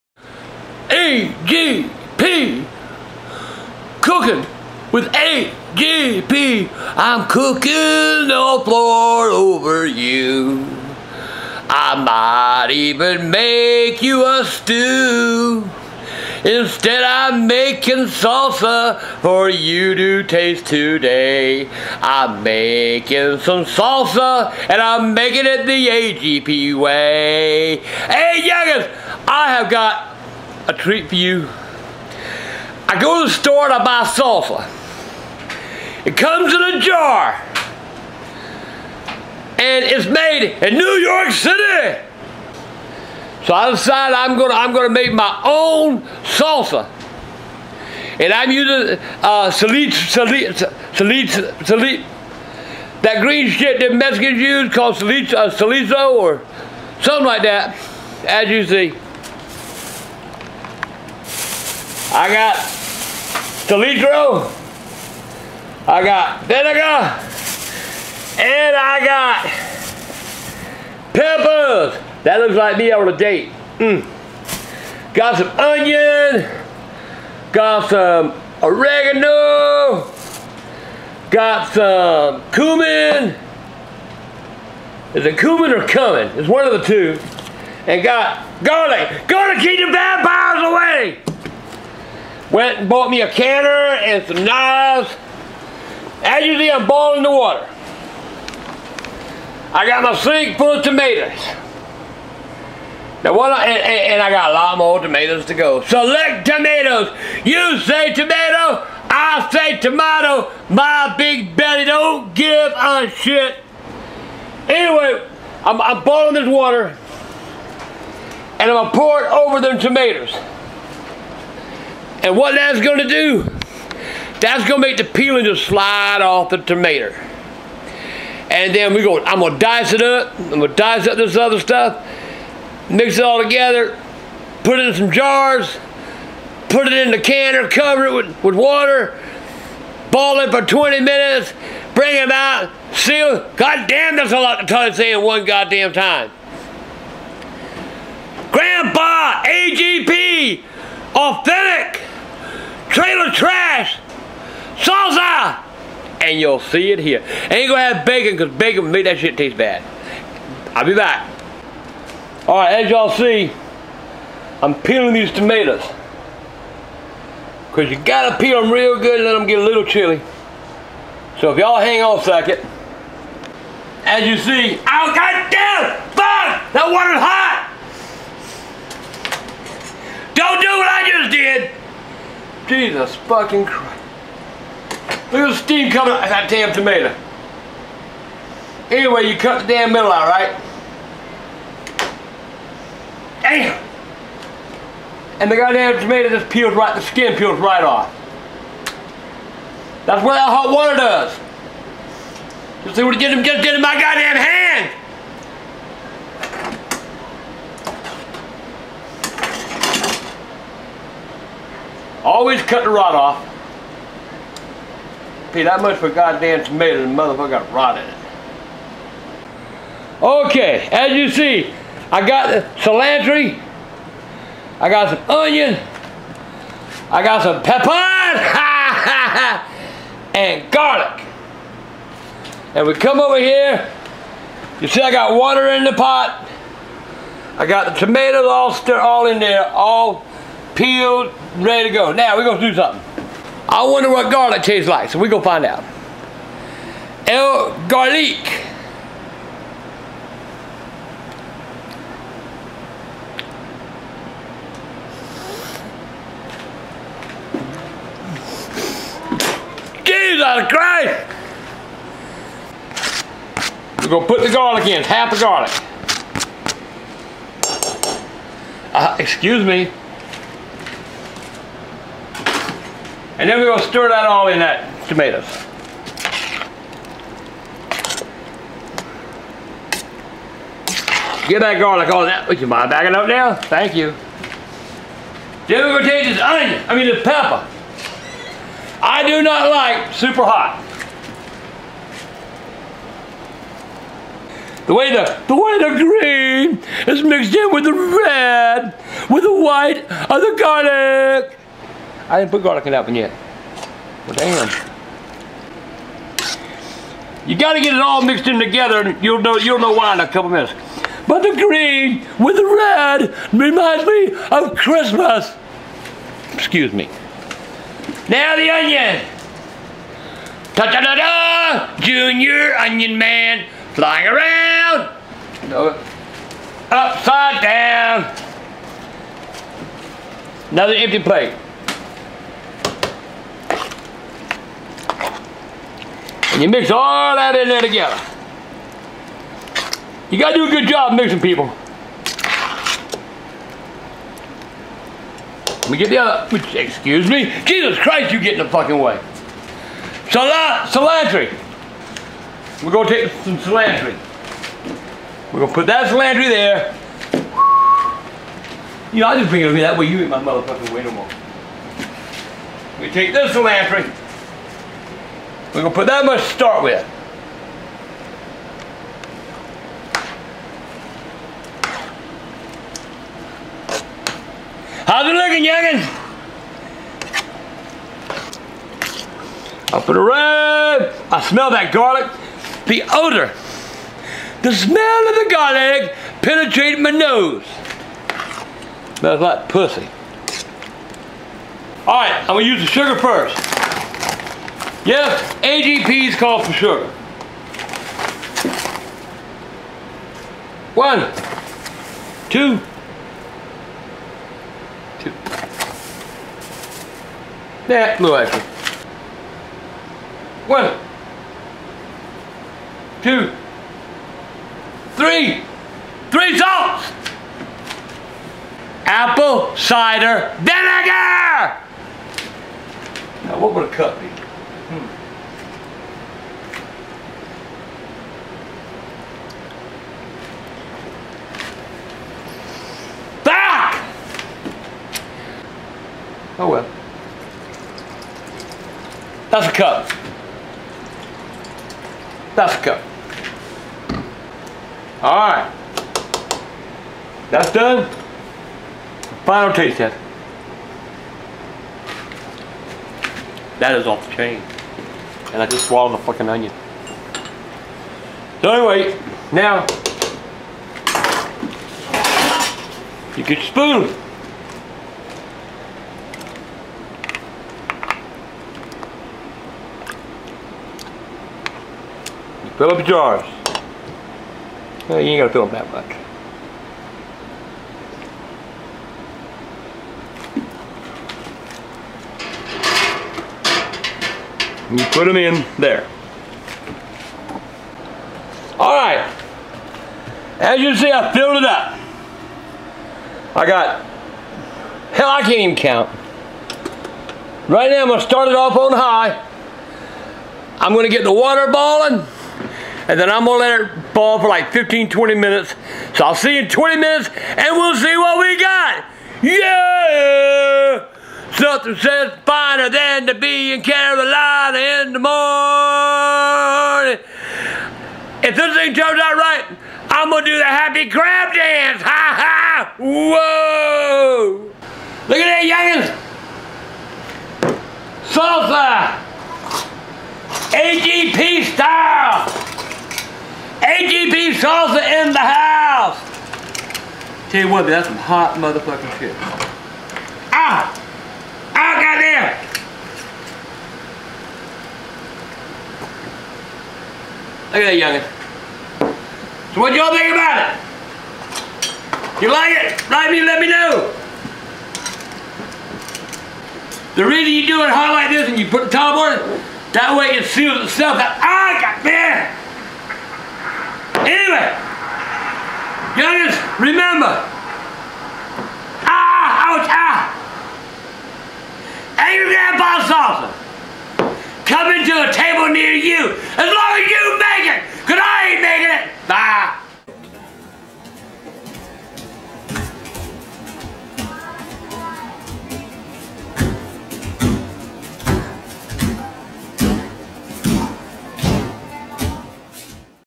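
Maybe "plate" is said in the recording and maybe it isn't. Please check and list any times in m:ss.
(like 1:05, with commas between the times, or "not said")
5:31.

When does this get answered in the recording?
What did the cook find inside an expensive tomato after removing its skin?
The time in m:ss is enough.
3:37.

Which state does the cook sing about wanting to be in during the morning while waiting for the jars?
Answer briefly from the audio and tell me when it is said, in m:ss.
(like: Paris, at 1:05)
Carolina, at 8:33.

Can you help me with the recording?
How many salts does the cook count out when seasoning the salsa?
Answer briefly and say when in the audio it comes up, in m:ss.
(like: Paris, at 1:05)
3, at 6:56.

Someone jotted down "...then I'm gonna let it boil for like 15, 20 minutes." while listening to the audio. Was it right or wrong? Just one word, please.
right.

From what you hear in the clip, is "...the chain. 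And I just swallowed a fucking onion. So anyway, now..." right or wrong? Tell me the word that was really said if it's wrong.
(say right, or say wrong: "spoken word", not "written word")
right.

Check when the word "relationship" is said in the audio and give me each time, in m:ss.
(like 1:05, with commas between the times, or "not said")
not said.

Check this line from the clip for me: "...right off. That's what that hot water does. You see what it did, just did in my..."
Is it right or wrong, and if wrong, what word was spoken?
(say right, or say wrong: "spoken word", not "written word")
right.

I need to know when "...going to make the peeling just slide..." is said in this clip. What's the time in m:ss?
2:04.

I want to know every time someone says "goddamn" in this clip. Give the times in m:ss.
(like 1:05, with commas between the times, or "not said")
2:25, 2:55, 3:15, 3:23, 3:36, 9:01, 9:21.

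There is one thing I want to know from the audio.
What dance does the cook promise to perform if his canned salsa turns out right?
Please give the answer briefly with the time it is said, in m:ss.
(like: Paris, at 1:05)
Happy crab dance, at 8:40.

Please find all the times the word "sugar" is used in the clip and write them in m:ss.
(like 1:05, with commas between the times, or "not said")
6:32.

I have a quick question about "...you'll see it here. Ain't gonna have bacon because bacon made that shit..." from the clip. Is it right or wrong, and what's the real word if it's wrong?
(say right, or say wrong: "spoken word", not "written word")
right.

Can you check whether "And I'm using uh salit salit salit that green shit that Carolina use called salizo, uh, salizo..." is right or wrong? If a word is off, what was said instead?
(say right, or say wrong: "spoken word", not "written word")
wrong: "Mexicans", not "Carolina".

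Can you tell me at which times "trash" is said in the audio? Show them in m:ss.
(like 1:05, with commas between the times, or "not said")
2:33.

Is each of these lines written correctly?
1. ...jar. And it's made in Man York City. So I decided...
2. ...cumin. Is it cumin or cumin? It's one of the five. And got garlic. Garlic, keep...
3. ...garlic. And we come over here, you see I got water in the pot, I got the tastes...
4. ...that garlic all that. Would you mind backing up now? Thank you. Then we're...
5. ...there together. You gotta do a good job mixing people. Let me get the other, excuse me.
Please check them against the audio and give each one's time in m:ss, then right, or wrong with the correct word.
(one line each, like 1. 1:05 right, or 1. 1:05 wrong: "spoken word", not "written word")
1. 0:36 wrong: "New", not "Man"
2. 1:22 wrong: "two", not "five"
3. 3:50 wrong: "tomatoes", not "tastes"
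4. 4:41 right
5. 5:37 right.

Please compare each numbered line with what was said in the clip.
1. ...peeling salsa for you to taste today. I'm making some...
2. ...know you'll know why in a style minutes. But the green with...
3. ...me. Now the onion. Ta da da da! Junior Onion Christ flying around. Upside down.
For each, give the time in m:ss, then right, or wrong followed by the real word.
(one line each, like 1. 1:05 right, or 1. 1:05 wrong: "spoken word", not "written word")
1. 0:17 wrong: "making", not "peeling"
2. 5:09 wrong: "couple", not "style"
3. 5:16 wrong: "Man", not "Christ".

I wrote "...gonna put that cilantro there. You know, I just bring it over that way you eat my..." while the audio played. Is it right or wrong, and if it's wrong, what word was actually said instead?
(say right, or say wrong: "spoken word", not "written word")
right.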